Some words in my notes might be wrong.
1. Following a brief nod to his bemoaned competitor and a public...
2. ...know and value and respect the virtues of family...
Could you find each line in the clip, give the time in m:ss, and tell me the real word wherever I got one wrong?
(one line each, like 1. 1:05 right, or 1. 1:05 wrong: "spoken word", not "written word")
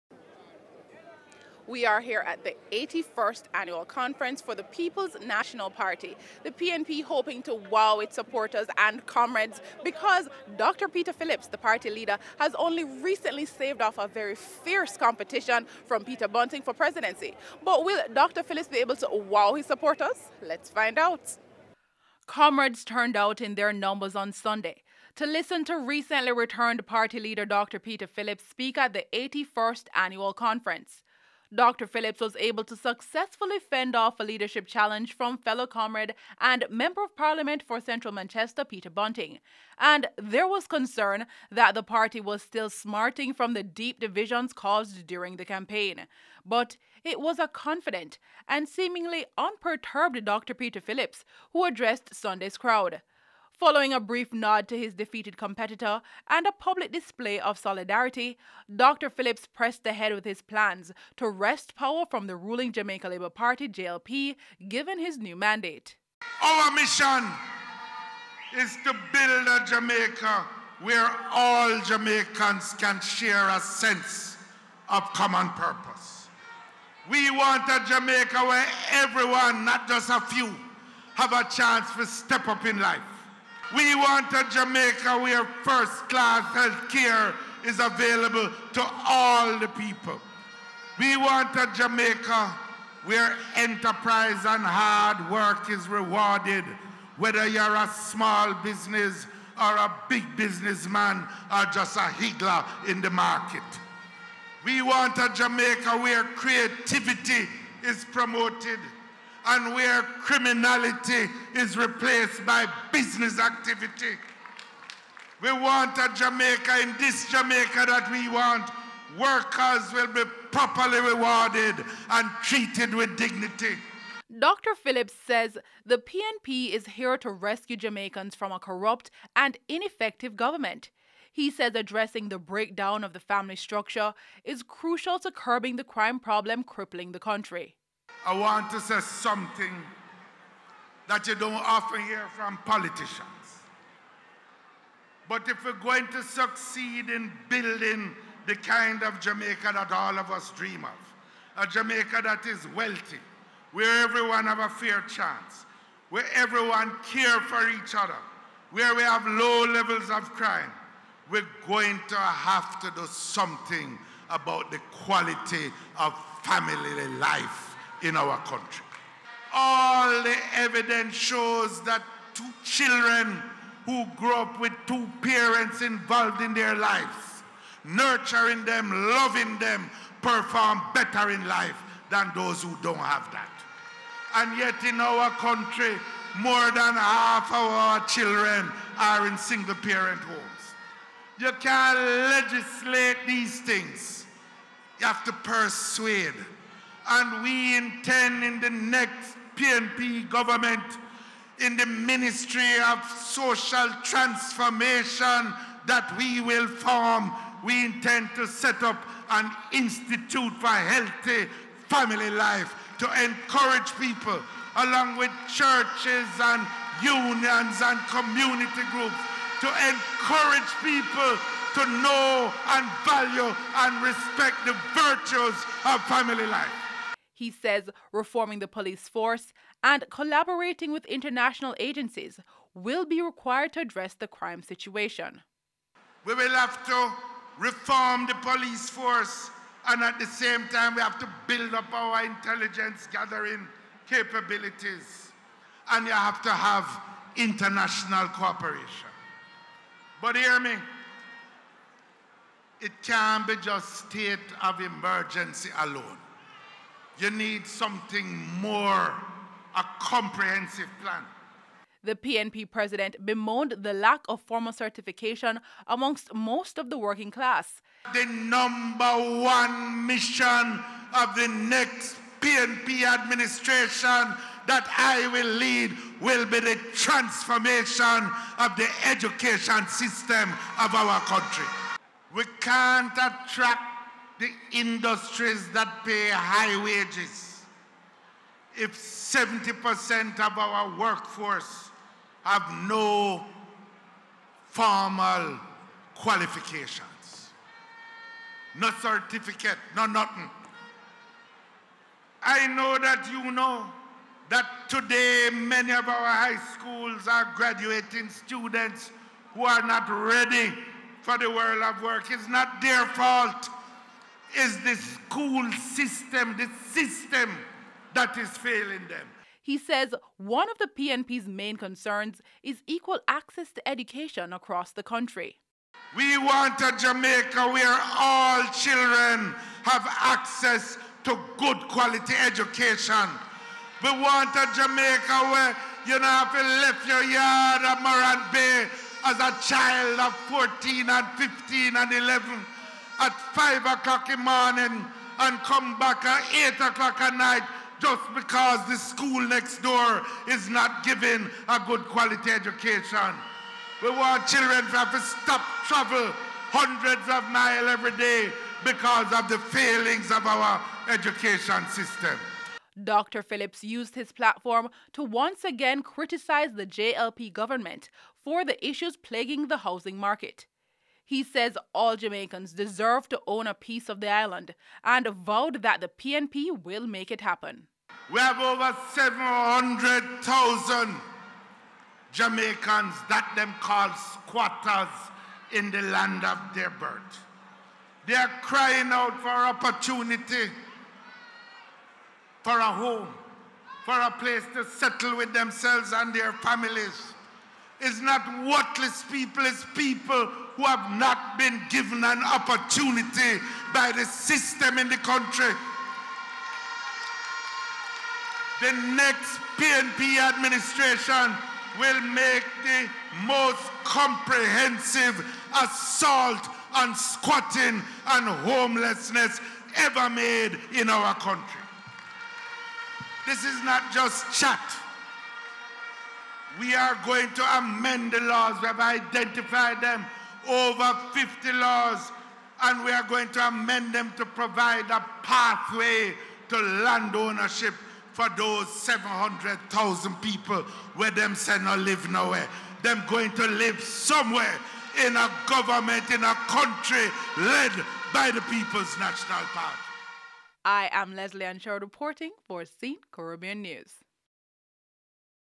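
1. 0:53 wrong: "defeated", not "bemoaned"
2. 3:41 right.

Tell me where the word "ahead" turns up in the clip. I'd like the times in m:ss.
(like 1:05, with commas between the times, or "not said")
0:59.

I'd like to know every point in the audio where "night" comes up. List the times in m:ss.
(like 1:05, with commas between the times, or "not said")
5:47.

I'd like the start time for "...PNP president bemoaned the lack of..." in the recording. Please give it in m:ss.
4:22.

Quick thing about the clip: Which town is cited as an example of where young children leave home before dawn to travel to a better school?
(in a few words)
Morant Bay.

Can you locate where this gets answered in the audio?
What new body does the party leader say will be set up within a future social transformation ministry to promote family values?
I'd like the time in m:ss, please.
3:29.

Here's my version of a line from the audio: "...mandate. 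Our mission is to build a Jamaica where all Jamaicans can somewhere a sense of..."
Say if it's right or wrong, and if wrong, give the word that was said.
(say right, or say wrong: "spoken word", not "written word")
wrong: "share", not "somewhere".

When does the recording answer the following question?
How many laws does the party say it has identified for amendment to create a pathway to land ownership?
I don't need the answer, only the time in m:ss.
7:10.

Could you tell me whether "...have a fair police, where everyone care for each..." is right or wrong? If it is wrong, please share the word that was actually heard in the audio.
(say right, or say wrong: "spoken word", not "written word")
wrong: "chance", not "police".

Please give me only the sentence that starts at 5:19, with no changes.
He says one of the PNP's main concerns is equal access to education across the country.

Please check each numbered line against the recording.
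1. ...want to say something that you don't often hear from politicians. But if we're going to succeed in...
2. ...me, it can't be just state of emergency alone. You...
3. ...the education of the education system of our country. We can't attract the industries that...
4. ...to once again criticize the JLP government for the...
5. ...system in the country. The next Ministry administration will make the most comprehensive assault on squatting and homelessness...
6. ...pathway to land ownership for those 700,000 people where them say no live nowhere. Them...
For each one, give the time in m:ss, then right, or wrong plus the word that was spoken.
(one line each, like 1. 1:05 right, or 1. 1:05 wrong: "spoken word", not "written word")
1. 2:18 right
2. 4:10 right
3. 4:36 wrong: "transformation", not "education"
4. 6:05 right
5. 6:44 wrong: "PNP", not "Ministry"
6. 7:15 right.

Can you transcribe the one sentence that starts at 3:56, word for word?
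We will have to reform the police force, and at the same time, we have to build up our intelligence gathering capabilities.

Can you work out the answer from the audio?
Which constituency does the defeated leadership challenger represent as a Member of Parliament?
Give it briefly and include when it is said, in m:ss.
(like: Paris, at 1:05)
Central Manchester, at 0:37.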